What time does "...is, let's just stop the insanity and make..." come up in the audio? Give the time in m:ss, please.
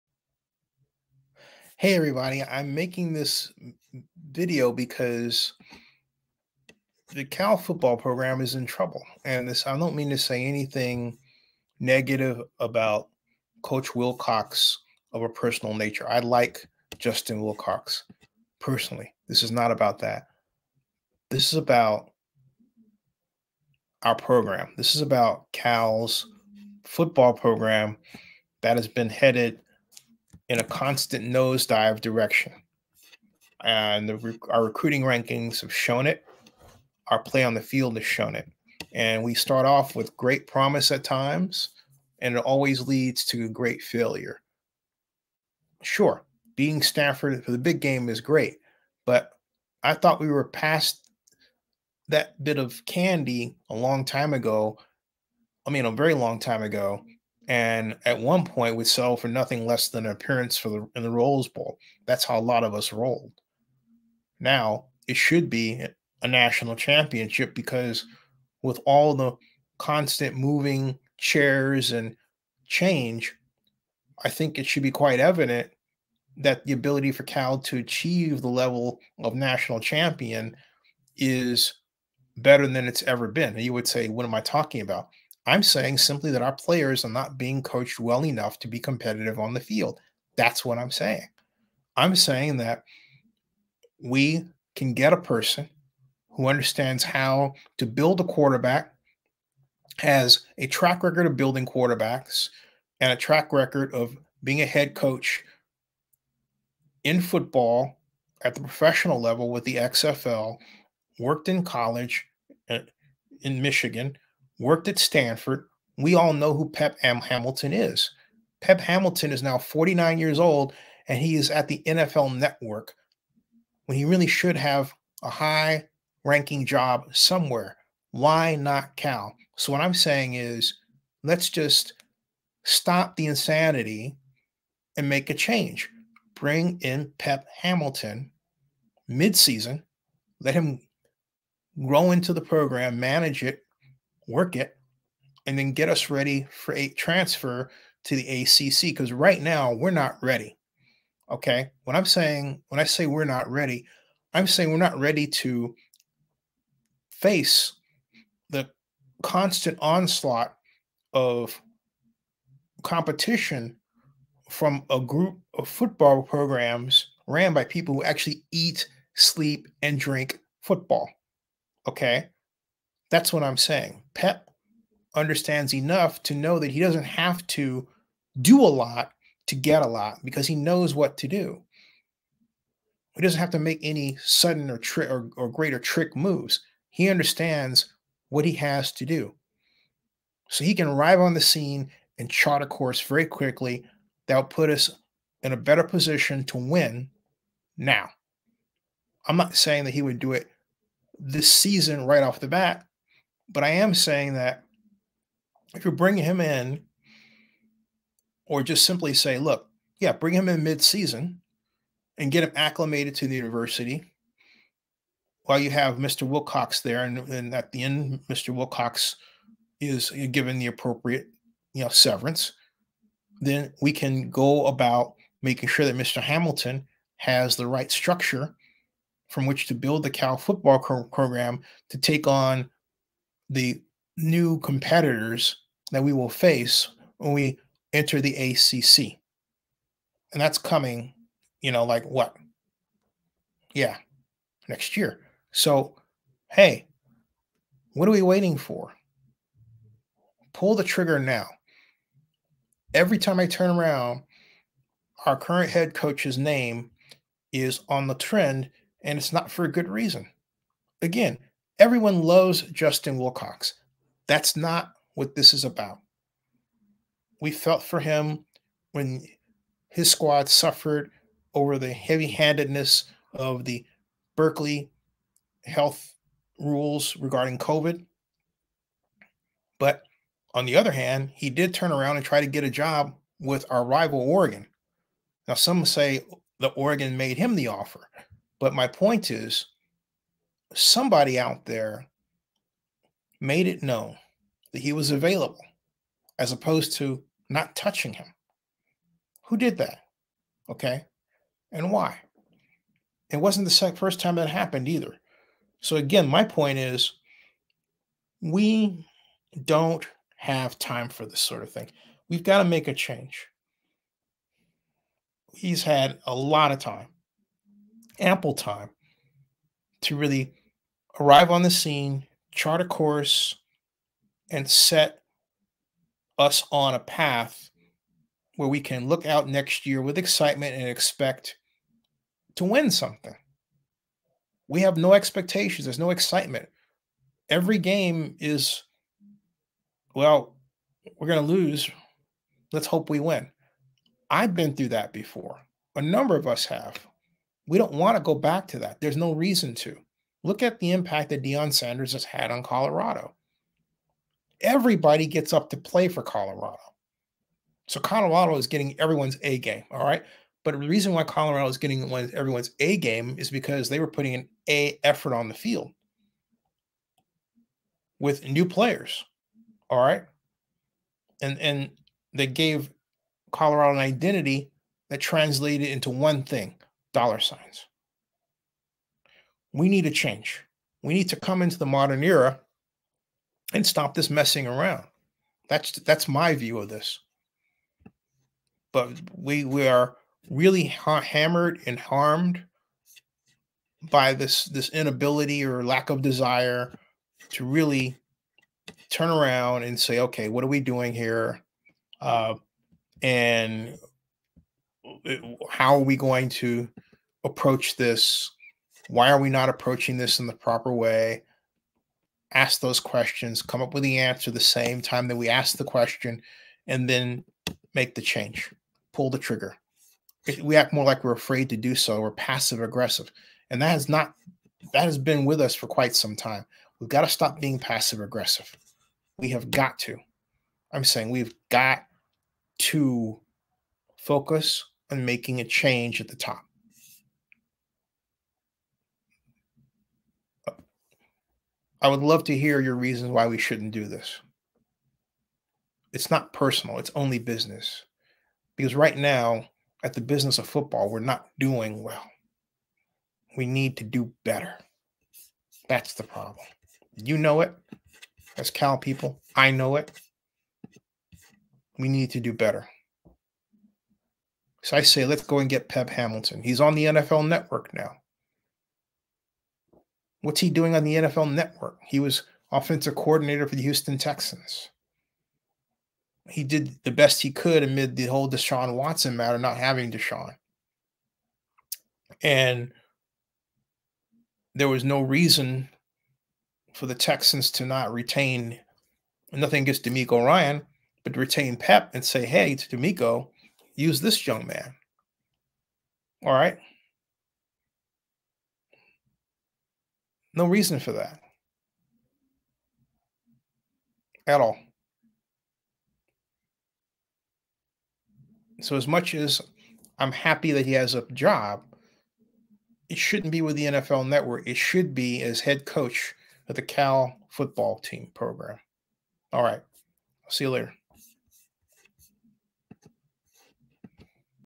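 2:10.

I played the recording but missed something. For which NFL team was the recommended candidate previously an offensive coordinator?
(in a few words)
Houston Texans.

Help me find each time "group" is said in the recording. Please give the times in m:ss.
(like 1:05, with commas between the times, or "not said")
2:44.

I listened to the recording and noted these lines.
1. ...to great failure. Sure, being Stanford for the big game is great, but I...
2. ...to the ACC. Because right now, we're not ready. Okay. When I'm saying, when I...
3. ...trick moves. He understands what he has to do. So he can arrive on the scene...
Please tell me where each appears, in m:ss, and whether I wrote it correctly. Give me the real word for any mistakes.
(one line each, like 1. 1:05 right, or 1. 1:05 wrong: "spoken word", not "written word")
1. 0:43 right
2. 2:28 right
3. 3:05 right.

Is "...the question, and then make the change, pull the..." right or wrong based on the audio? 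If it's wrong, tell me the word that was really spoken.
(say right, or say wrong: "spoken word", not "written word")
right.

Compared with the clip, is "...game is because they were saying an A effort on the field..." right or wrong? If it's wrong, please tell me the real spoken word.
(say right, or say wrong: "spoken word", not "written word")
wrong: "putting", not "saying".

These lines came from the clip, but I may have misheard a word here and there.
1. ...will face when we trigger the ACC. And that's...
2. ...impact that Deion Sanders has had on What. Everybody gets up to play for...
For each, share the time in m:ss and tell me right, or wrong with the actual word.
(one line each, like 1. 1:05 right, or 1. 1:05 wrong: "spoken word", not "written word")
1. 3:56 wrong: "enter", not "trigger"
2. 5:50 wrong: "Colorado", not "What".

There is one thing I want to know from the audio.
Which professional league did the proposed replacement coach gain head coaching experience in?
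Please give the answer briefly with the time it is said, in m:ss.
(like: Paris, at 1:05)
XFL, at 1:49.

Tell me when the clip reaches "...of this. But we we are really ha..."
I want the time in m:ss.
6:26.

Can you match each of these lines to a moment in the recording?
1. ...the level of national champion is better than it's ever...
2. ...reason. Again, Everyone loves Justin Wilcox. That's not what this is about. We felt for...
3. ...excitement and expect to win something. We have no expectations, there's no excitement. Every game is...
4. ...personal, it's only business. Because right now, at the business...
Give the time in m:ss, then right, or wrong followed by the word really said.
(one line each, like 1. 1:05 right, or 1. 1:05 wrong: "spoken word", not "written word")
1. 1:18 right
2. 4:19 right
3. 5:30 right
4. 7:26 right.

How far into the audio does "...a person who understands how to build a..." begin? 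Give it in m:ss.
1:35.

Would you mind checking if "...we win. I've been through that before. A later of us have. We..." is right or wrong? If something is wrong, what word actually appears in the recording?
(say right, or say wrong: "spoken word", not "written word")
wrong: "number", not "later".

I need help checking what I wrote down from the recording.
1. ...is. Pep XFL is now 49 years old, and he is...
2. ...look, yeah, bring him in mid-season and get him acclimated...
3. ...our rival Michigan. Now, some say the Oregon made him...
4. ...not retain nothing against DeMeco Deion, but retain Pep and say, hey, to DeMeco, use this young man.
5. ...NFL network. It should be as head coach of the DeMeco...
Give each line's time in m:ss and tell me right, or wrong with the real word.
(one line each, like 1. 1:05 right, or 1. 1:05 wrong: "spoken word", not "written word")
1. 1:57 wrong: "Hamilton", not "XFL"
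2. 3:29 right
3. 4:43 wrong: "Oregon", not "Michigan"
4. 8:07 wrong: "Ryan", not "Deion"
5. 8:33 wrong: "Cal", not "DeMeco".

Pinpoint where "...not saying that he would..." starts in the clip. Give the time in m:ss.
3:19.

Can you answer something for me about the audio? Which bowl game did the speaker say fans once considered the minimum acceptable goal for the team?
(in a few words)
Rose Bowl.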